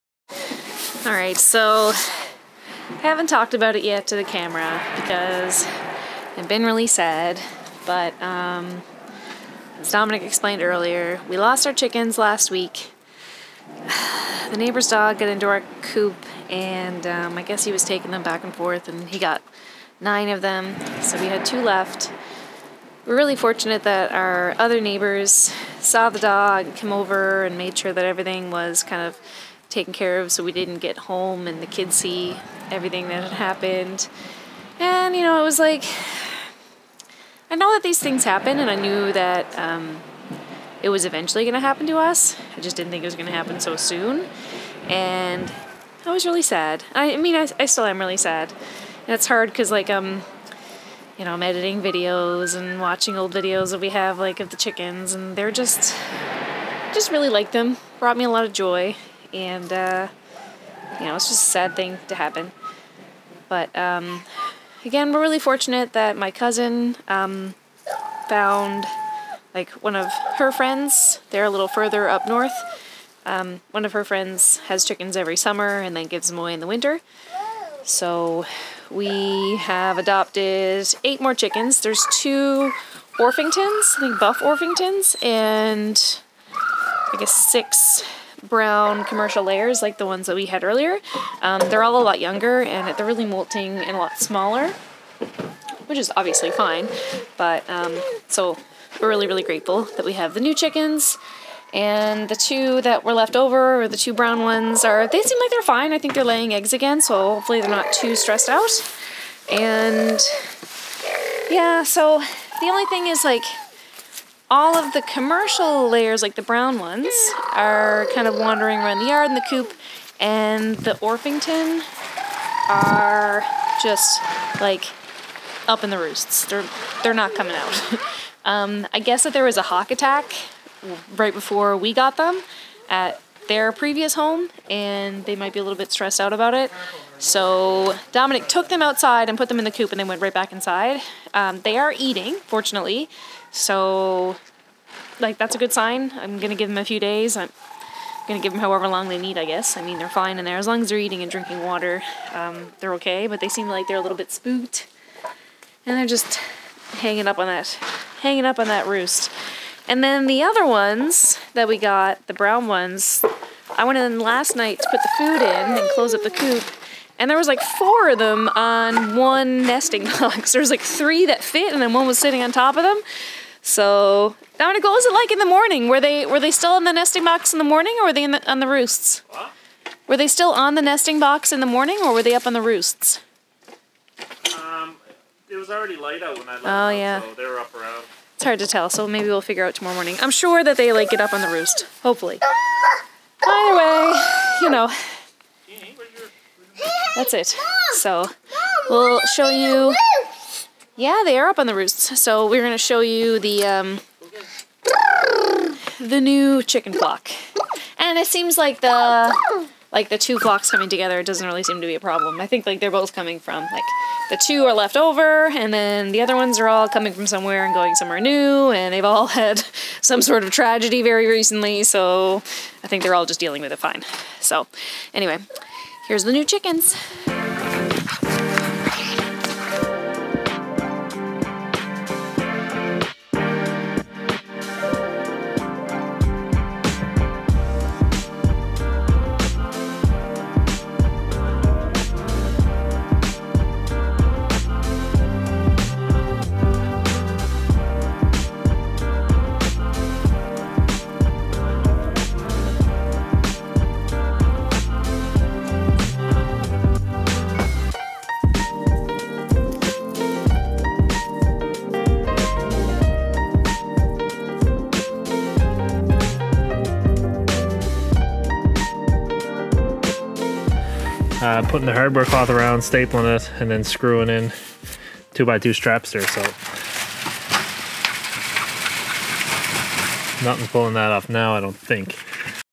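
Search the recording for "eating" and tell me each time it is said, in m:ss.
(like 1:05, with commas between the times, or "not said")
2:21, 2:30.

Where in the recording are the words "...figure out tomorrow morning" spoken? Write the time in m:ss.
3:09.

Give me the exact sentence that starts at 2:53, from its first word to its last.
So, Dominic, what was it like in the morning?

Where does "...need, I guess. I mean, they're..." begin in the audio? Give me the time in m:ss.
2:29.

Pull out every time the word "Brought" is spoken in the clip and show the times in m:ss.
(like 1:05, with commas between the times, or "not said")
0:57.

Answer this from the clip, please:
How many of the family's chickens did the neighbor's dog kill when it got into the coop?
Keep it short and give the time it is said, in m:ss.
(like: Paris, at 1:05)
9, at 0:20.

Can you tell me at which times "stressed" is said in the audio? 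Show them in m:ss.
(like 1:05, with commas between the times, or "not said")
1:48, 2:15.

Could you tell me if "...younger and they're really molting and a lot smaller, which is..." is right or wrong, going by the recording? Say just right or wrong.
right.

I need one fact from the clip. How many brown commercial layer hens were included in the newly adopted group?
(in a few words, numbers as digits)
6.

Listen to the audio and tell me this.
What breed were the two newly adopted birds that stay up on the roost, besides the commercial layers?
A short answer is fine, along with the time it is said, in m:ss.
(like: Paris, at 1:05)
Buff Orpingtons, at 1:24.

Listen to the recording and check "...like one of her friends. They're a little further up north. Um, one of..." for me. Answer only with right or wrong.
right.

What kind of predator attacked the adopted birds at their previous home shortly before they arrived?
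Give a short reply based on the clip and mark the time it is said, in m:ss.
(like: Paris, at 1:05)
a hawk, at 2:09.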